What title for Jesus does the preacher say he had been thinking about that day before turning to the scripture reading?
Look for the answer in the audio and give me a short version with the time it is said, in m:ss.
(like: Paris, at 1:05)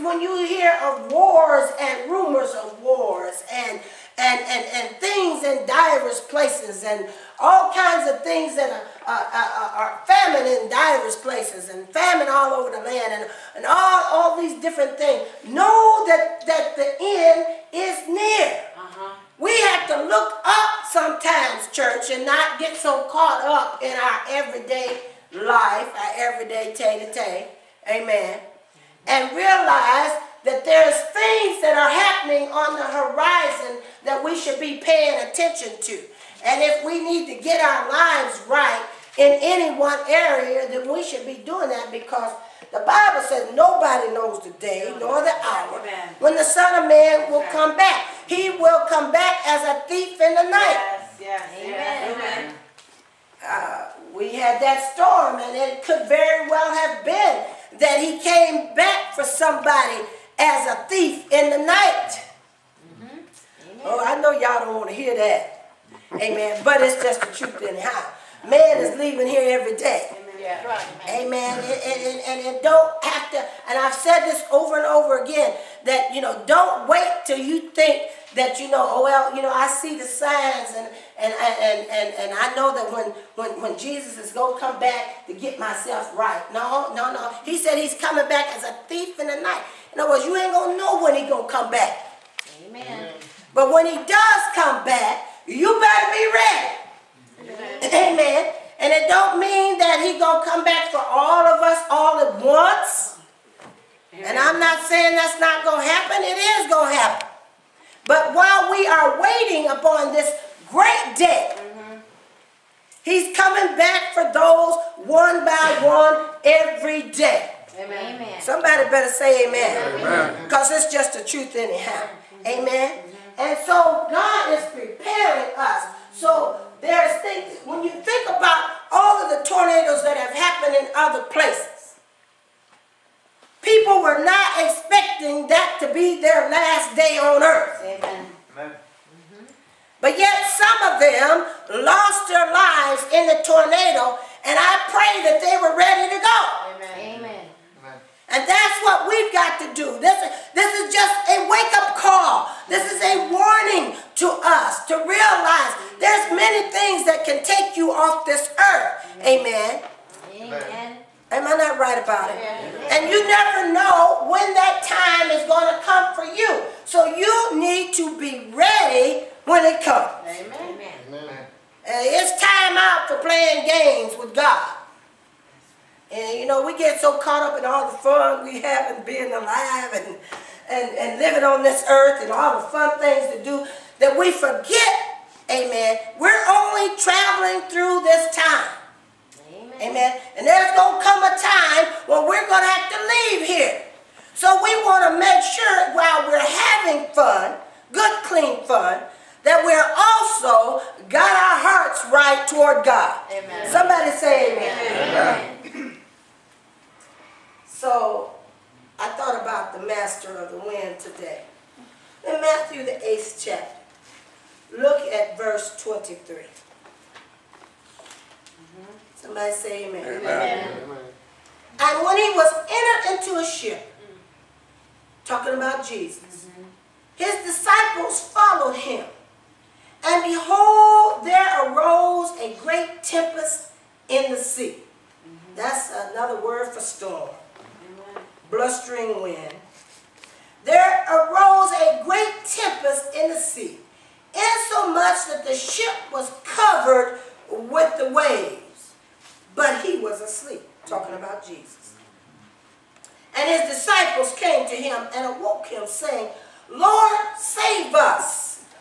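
the master of the wind, at 3:29.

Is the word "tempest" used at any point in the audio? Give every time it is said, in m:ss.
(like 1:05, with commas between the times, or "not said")
3:53, 4:02.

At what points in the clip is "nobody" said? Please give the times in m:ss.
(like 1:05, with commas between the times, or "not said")
0:43.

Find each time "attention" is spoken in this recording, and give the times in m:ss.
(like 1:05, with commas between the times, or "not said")
0:35.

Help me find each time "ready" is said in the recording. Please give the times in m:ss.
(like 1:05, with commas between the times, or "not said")
1:36, 2:25, 2:48.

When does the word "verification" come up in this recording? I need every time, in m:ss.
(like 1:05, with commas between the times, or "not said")
not said.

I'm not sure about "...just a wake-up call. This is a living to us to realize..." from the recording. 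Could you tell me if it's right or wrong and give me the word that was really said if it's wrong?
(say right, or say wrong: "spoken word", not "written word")
wrong: "warning", not "living".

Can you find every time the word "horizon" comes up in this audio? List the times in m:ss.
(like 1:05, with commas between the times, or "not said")
0:32.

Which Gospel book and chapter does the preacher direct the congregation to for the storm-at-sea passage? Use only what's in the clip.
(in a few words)
Matthew 8.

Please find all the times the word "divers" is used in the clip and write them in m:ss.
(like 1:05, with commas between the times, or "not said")
0:05, 0:10.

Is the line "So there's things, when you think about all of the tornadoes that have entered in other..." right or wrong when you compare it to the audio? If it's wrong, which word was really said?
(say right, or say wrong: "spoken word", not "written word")
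wrong: "happened", not "entered".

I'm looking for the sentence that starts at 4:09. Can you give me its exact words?
But he was asleep, talking about Jesus.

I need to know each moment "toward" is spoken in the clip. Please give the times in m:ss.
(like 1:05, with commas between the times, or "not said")
3:22.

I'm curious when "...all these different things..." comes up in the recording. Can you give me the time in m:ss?
0:14.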